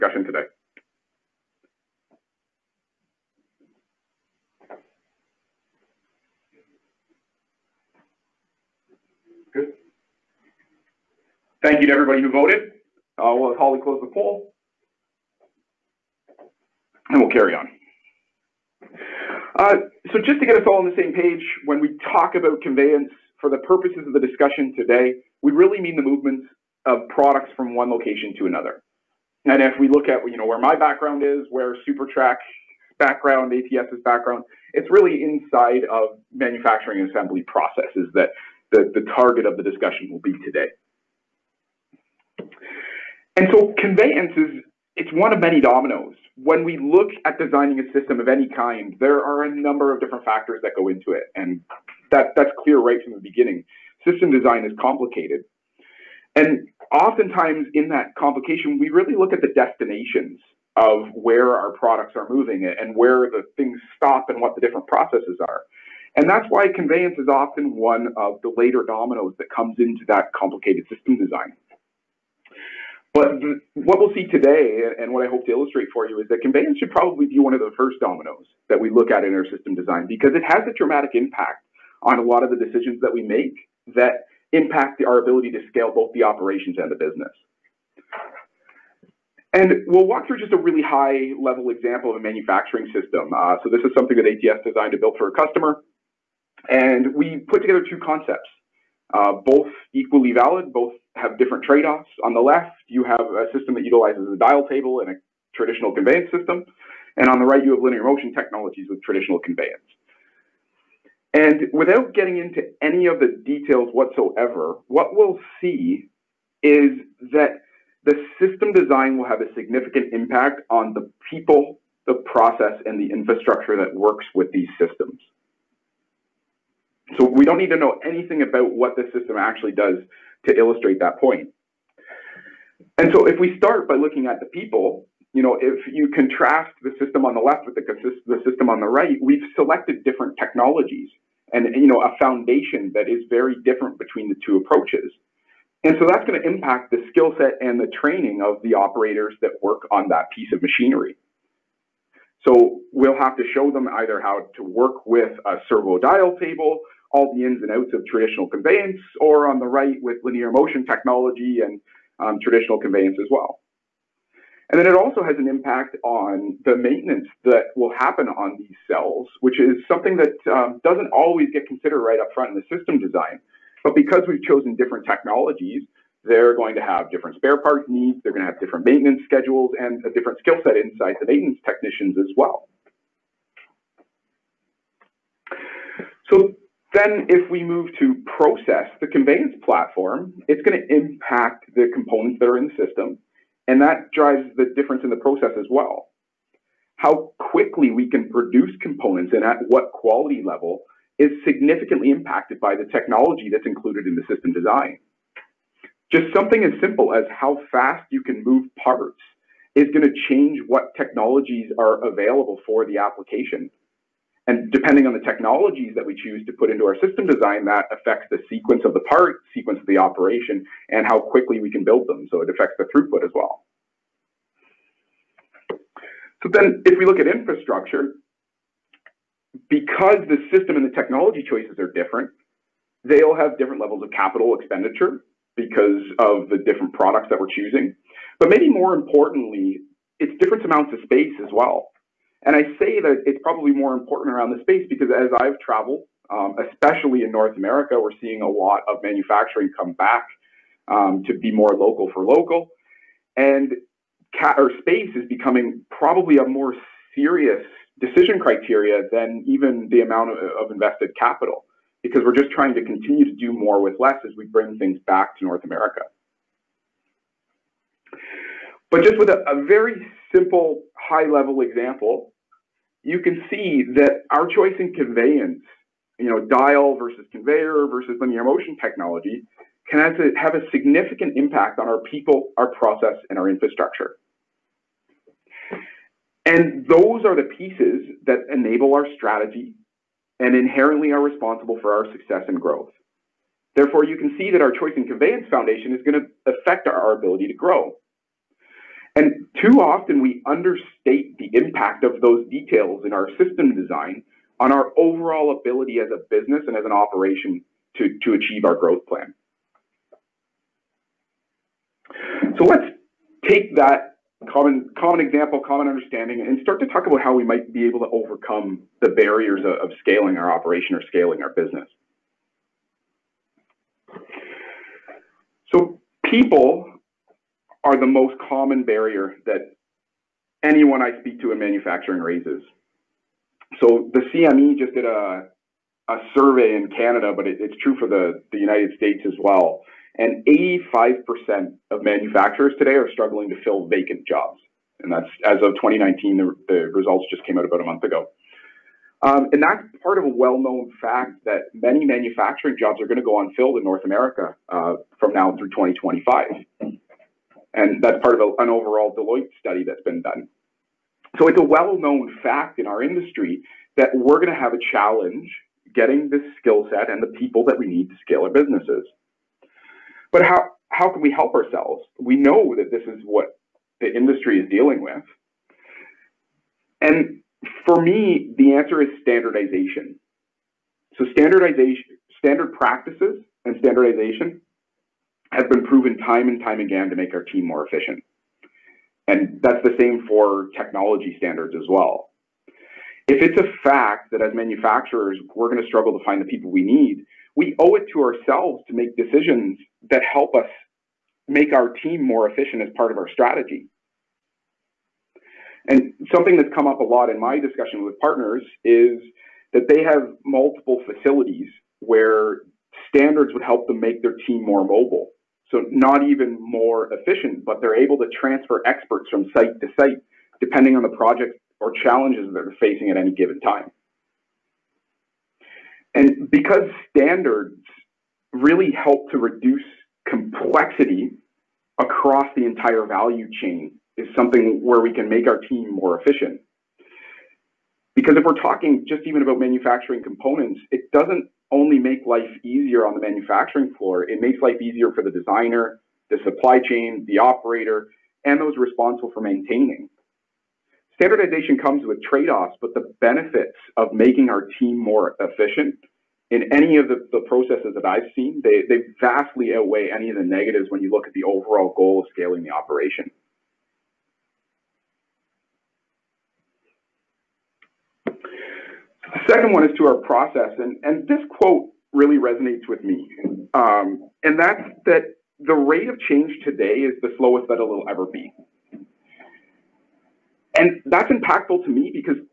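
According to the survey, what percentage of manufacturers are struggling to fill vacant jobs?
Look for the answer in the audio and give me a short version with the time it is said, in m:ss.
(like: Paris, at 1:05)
85%, at 5:40.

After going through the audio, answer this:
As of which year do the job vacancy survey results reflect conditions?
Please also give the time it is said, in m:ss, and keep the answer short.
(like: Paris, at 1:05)
2019, at 5:45.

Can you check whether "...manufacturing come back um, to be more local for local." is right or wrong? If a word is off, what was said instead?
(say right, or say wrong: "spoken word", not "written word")
right.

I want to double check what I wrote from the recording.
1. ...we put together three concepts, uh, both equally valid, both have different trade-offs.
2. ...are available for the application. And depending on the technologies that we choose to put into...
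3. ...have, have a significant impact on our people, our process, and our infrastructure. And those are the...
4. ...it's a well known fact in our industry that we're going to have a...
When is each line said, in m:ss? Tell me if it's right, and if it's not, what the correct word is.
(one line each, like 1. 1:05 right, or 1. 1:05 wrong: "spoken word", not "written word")
1. 1:37 wrong: "two", not "three"
2. 3:31 right
3. 4:39 right
4. 6:01 right.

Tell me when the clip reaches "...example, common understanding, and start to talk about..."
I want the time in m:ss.
5:15.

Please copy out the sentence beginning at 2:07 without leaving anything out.
So we don't need to know anything about what the system actually does to illustrate that point.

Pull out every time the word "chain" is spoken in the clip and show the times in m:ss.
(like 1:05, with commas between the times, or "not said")
7:13, 7:26.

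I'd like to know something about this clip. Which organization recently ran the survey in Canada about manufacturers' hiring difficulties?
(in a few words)
CME.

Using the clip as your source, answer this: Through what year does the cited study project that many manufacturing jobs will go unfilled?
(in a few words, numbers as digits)
2025.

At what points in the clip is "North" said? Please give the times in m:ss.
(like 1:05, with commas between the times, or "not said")
4:07, 4:25, 5:53.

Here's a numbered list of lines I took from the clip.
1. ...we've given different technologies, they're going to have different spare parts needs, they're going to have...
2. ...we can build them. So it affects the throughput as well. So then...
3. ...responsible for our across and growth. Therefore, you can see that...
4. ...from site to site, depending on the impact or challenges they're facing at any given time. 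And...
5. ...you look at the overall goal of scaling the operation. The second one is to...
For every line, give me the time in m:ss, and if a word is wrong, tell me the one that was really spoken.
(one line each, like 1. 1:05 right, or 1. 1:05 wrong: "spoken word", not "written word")
1. 2:54 wrong: "chosen", not "given"
2. 3:41 right
3. 4:51 wrong: "success", not "across"
4. 6:59 wrong: "project", not "impact"
5. 7:41 right.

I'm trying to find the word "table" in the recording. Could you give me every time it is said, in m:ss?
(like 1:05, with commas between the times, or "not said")
1:44, 2:36.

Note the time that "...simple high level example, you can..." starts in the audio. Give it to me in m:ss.
4:30.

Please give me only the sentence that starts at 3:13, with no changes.
And that drives the difference in the process as well.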